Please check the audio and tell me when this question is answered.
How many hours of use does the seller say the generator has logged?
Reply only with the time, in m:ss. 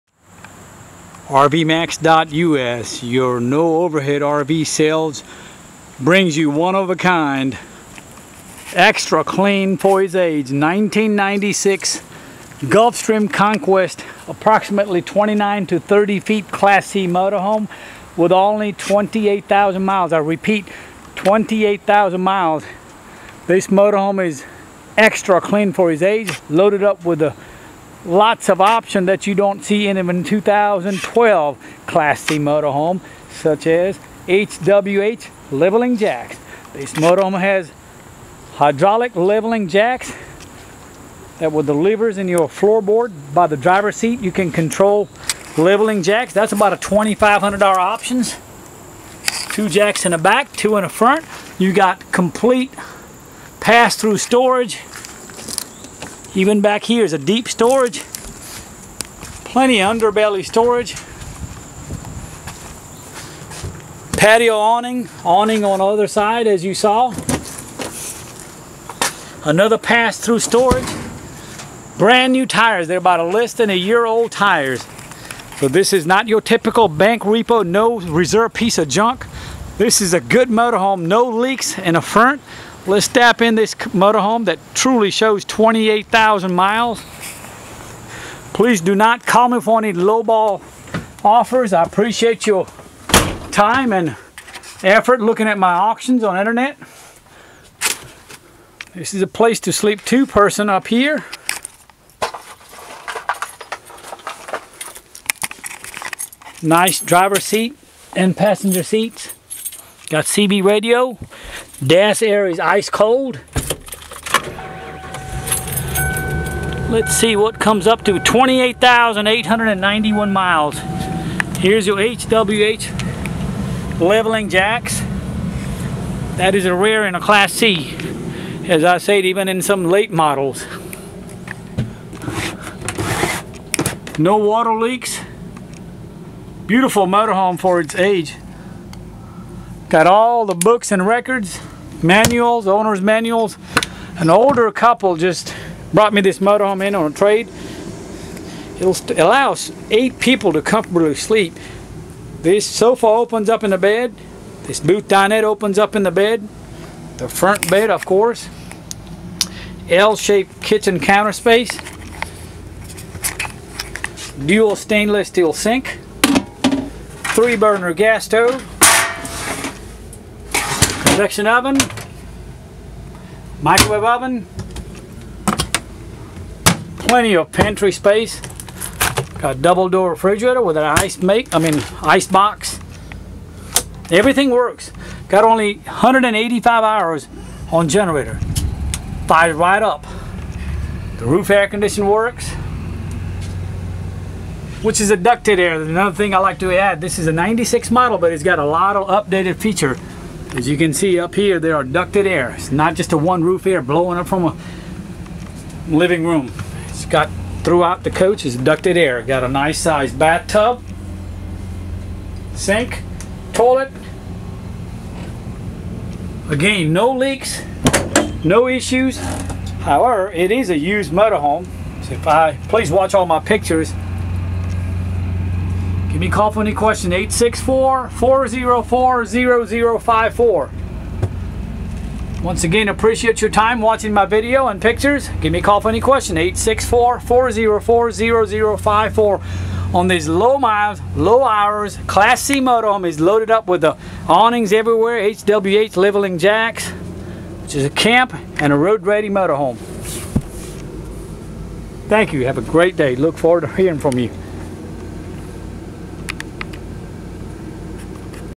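3:05.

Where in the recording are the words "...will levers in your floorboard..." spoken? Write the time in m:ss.
0:41.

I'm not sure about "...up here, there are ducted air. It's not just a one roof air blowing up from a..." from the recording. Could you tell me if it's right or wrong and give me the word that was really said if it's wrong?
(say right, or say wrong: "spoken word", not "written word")
right.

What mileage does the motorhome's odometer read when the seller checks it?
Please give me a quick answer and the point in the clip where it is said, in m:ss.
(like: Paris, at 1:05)
28,891, at 1:58.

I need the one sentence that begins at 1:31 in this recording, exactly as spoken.
I appreciate your time and effort looking at my auctions on internet.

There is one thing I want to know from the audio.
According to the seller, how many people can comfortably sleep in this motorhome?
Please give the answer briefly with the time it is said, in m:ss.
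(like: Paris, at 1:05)
8, at 2:29.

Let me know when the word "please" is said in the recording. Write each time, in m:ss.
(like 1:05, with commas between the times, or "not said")
1:28, 3:42.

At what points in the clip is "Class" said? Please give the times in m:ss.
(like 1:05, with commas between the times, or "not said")
0:16, 0:31, 2:07, 4:02.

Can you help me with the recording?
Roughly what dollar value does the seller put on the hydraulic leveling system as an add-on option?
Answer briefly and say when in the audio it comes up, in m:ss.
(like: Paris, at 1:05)
$2,500, at 0:46.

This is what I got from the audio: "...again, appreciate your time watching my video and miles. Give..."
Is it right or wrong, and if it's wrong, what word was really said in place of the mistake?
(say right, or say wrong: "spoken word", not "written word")
wrong: "pictures", not "miles".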